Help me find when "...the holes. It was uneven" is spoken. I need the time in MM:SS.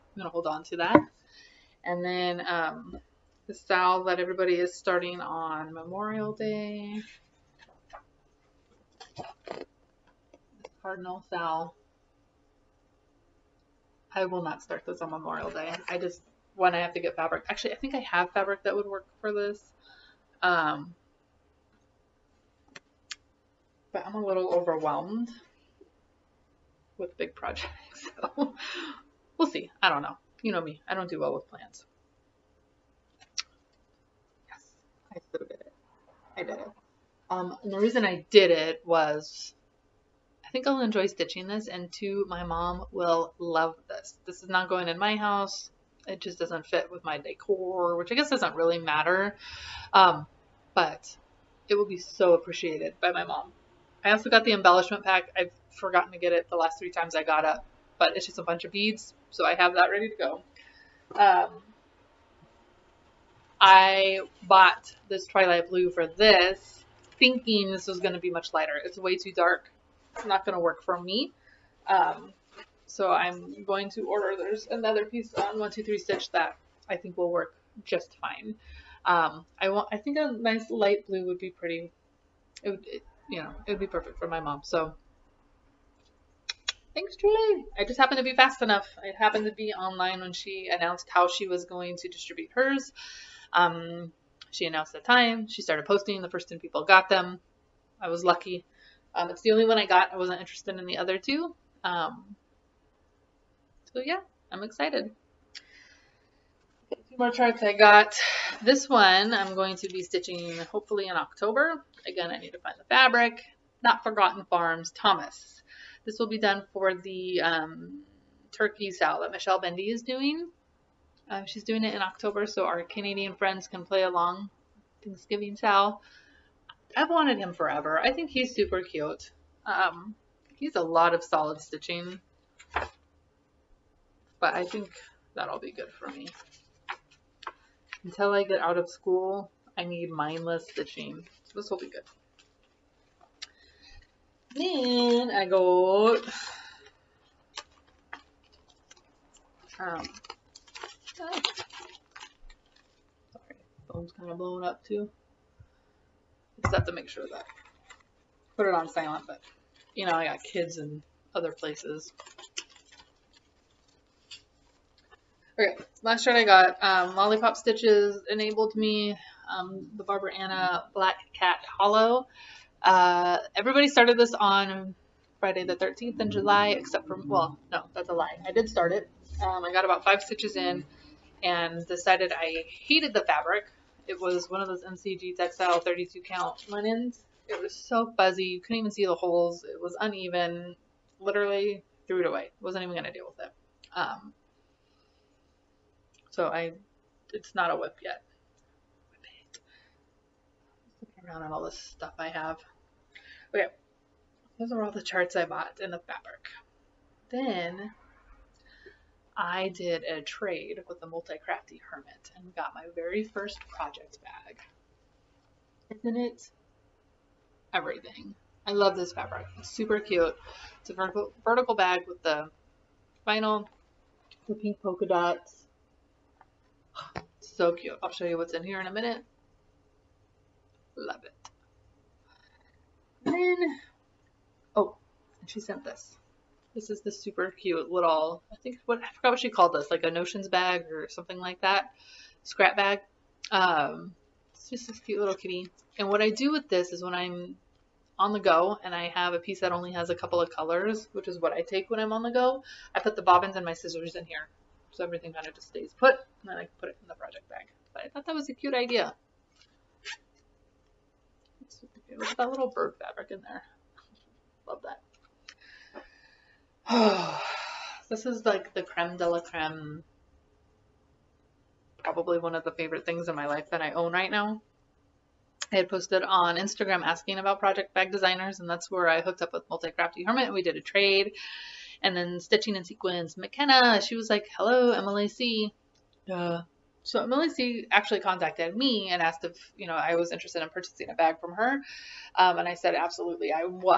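03:09.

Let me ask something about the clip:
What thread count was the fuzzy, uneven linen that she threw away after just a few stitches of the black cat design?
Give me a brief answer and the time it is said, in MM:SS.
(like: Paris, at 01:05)
32, at 03:05.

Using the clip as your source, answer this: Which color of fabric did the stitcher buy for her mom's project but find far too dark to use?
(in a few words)
Twilight Blue.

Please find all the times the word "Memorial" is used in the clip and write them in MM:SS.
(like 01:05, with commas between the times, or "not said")
00:05, 00:15.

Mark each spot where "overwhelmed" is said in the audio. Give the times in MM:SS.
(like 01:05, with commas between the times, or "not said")
00:24.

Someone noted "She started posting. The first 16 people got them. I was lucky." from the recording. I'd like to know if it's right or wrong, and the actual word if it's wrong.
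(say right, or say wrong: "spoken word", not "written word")
wrong: "10", not "16".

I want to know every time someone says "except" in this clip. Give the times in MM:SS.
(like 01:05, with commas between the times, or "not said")
02:56.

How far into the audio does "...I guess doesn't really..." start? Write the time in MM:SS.
00:48.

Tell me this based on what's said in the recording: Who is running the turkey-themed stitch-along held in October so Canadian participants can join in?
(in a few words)
Michelle Bendy.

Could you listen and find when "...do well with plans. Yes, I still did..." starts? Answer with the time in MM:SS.
00:31.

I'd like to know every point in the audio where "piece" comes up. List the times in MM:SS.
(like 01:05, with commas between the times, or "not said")
01:15, 04:09.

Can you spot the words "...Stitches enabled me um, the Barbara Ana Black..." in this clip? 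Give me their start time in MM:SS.
02:47.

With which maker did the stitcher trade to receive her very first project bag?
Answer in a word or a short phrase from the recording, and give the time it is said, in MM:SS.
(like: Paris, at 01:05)
Multi-Crafty Hermit, at 03:31.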